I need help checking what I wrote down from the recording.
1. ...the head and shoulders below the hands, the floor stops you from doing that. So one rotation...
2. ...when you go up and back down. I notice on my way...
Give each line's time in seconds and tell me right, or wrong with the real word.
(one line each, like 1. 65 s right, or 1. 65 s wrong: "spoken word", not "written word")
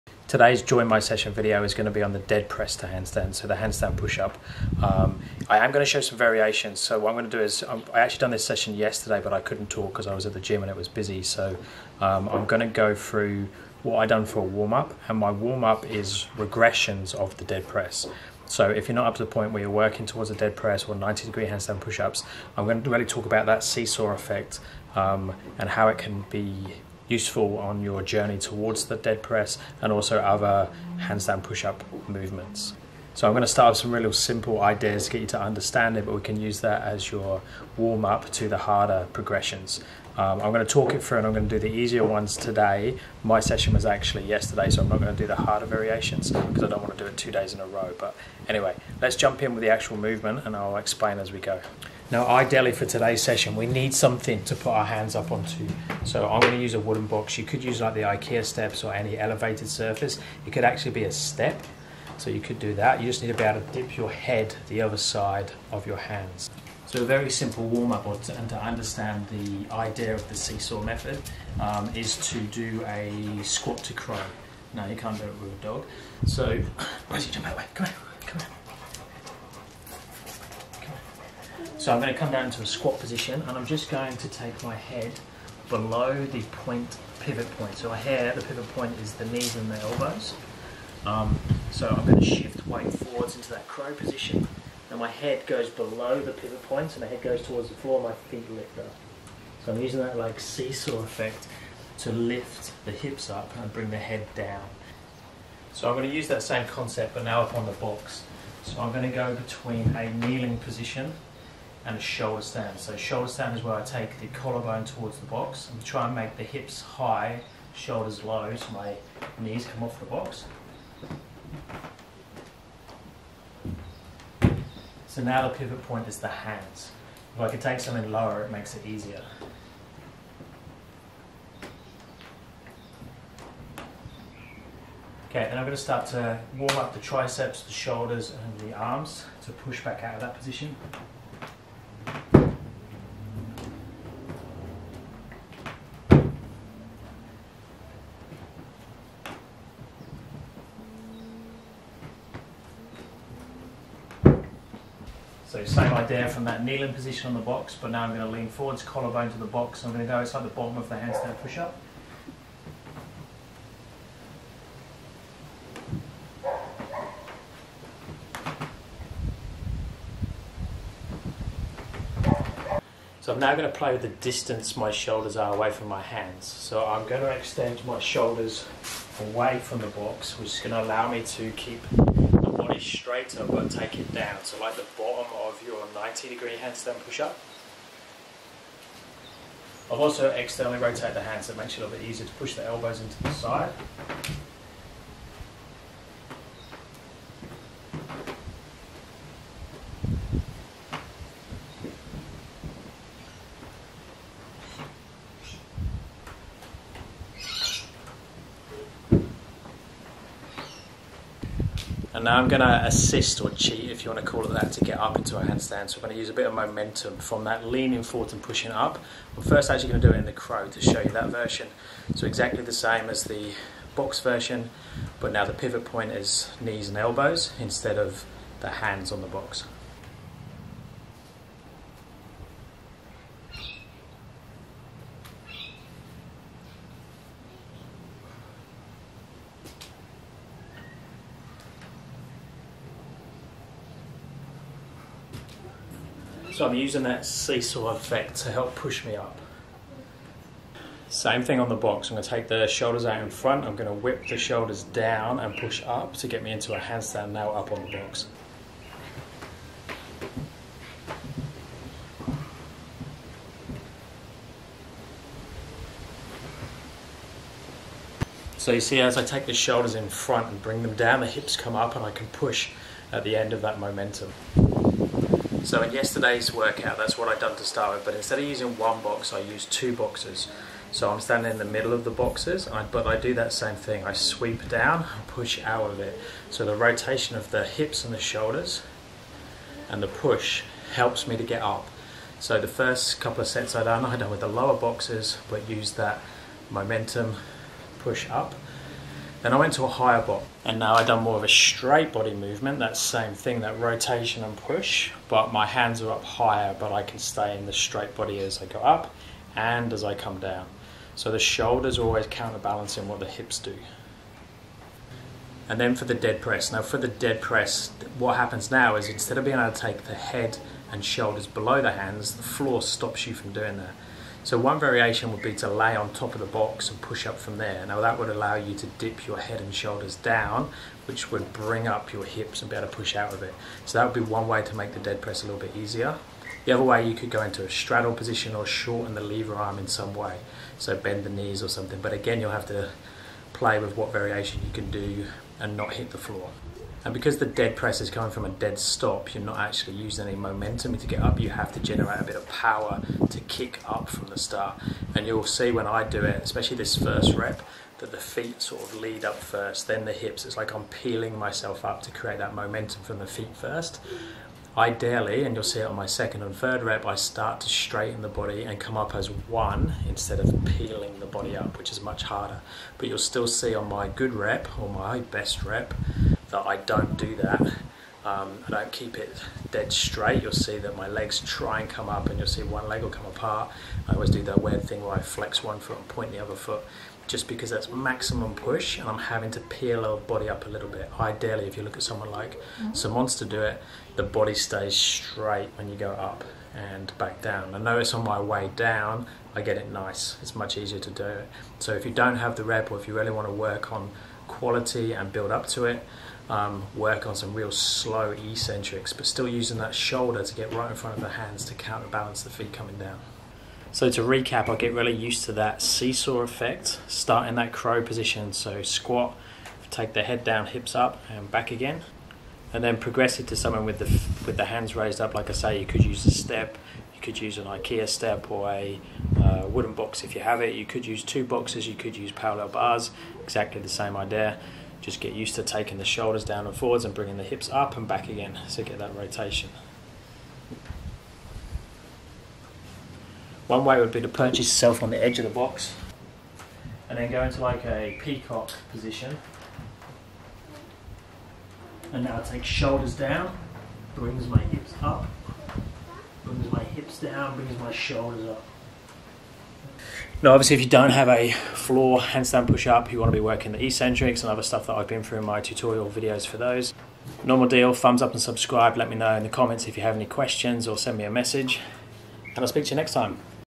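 1. 320 s wrong: "variation", not "rotation"
2. 395 s right.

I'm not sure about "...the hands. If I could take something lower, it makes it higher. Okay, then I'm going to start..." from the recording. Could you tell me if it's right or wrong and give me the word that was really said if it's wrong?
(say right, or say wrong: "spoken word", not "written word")
wrong: "easier", not "higher".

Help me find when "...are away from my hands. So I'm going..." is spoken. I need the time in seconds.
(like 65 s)
175 s.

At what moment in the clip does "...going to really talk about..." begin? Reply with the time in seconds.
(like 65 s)
22 s.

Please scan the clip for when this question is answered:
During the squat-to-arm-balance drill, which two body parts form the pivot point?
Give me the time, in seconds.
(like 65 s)
89 s.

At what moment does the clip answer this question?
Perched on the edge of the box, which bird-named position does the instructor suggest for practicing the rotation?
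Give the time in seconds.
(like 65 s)
448 s.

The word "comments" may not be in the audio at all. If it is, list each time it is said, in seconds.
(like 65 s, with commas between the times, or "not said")
469 s.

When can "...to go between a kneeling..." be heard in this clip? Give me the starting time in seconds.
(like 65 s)
109 s.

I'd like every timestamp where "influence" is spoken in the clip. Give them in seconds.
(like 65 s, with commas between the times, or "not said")
not said.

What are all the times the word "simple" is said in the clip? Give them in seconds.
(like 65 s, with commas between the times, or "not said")
34 s, 67 s.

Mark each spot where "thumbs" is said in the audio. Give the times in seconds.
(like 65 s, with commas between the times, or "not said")
467 s.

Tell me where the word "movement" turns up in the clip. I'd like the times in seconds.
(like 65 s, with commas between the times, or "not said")
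32 s, 49 s, 302 s.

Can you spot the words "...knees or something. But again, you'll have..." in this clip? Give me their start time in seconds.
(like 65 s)
341 s.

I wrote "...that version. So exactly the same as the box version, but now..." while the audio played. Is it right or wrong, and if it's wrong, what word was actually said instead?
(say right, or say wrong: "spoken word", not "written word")
right.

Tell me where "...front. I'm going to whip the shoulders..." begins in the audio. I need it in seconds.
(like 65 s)
253 s.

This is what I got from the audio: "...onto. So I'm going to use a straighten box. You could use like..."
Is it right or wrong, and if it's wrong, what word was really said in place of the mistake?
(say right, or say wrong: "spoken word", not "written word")
wrong: "wooden", not "straighten".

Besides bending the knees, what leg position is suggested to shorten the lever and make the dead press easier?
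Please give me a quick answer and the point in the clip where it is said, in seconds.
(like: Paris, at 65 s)
Straddle, at 337 s.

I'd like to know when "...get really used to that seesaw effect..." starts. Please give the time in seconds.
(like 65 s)
414 s.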